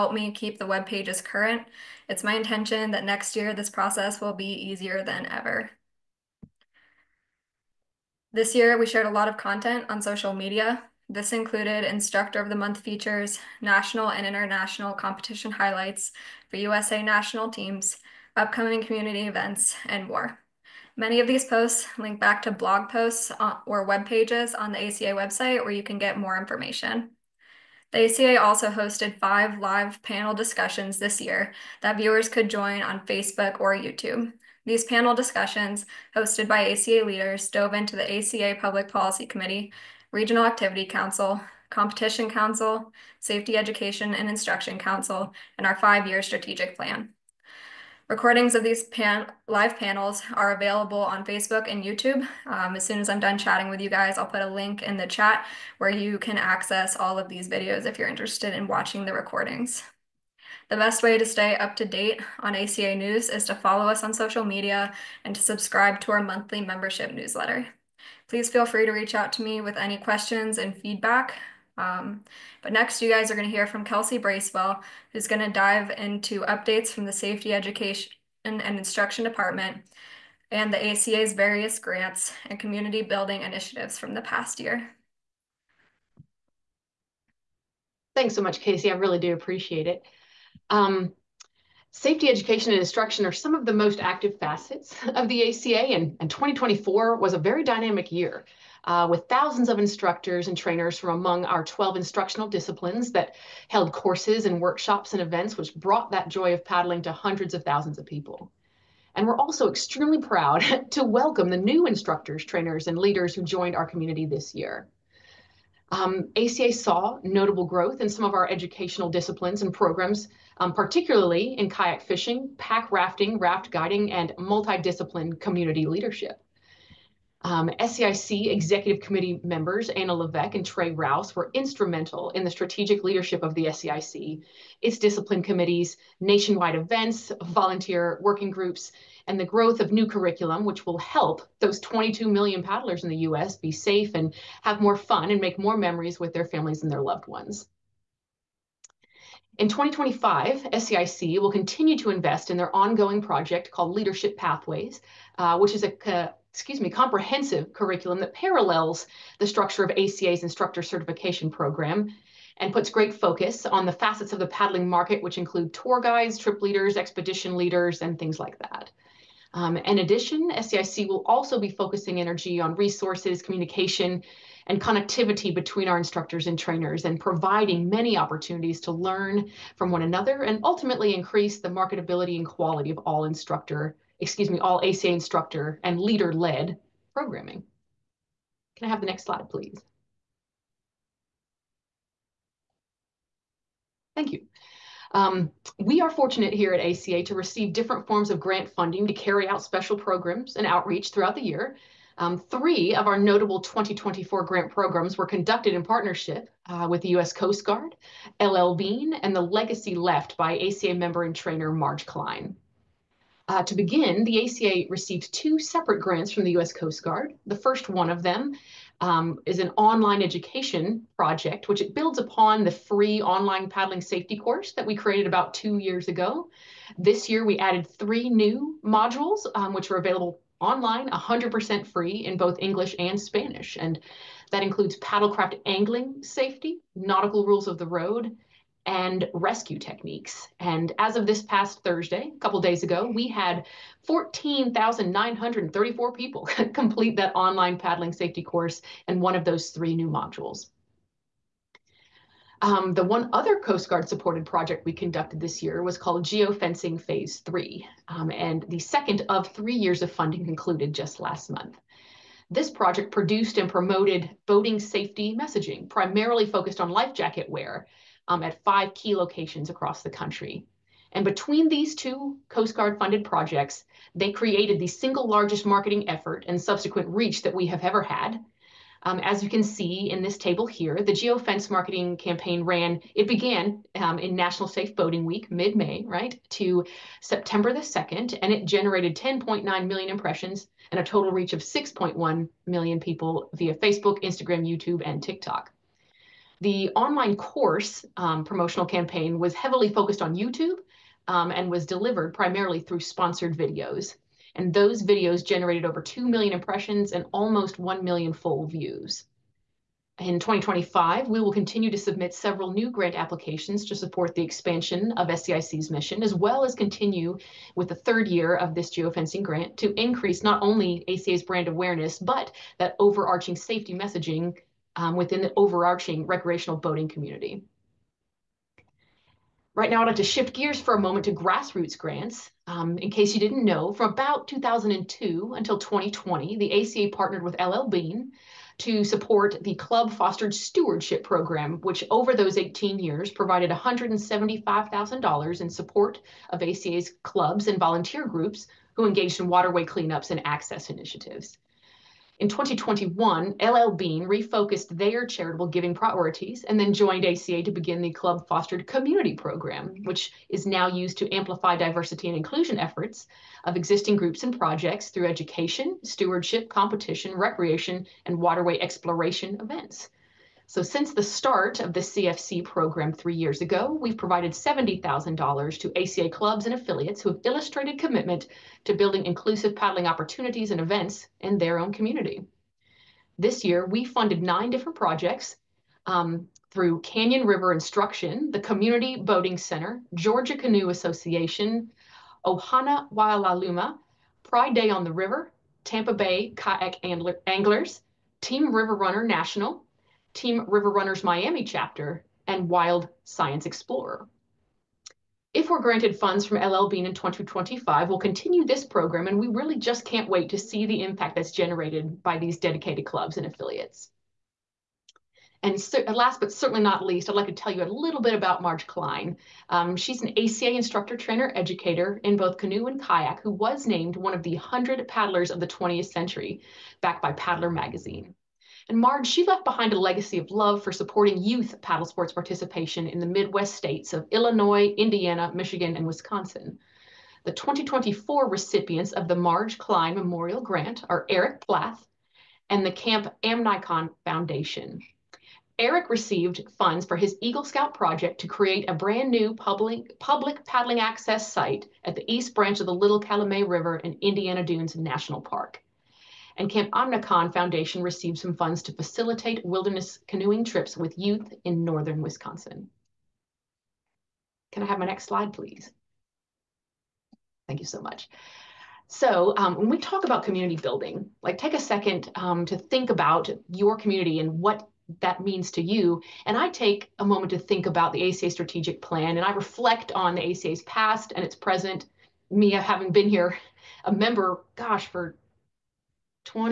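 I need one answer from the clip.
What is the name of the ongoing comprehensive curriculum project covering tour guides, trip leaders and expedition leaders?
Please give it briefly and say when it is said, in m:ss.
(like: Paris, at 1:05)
Leadership Pathways, at 2:33.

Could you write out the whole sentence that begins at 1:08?
Please feel free to reach out to me with any questions and feedback.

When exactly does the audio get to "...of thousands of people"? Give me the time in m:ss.
1:47.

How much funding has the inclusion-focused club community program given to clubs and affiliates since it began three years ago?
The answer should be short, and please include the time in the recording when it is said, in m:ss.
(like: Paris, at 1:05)
$70,000, at 6:14.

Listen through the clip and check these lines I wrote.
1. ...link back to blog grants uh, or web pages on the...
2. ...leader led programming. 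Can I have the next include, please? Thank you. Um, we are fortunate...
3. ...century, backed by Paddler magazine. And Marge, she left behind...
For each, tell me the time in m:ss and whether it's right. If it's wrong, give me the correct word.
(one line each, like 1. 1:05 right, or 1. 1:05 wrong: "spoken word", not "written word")
1. 0:21 wrong: "posts", not "grants"
2. 3:05 wrong: "slide", not "include"
3. 7:06 right.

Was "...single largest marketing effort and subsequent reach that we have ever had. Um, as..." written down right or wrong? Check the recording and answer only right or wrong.
right.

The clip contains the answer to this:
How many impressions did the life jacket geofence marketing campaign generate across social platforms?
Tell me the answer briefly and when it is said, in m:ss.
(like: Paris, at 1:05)
10.9 million, at 4:49.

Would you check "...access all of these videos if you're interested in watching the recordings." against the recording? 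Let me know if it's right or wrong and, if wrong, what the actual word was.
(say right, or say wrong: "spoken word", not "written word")
right.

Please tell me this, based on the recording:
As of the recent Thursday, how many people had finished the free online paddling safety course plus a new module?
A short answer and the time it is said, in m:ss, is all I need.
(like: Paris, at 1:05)
14,934, at 4:04.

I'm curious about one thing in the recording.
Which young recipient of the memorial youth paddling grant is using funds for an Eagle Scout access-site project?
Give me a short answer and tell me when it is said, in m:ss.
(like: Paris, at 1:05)
Eric Plath, at 7:21.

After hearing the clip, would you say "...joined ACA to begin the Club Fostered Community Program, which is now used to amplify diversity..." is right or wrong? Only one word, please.
right.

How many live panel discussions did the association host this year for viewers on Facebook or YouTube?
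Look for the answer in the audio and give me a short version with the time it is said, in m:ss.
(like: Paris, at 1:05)
5, at 0:29.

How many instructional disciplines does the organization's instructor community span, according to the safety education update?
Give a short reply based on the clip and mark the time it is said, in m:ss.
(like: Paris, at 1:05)
12, at 1:41.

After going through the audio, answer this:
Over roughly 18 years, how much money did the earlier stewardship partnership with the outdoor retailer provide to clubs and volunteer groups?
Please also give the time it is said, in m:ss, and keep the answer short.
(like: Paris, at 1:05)
$175,000, at 5:43.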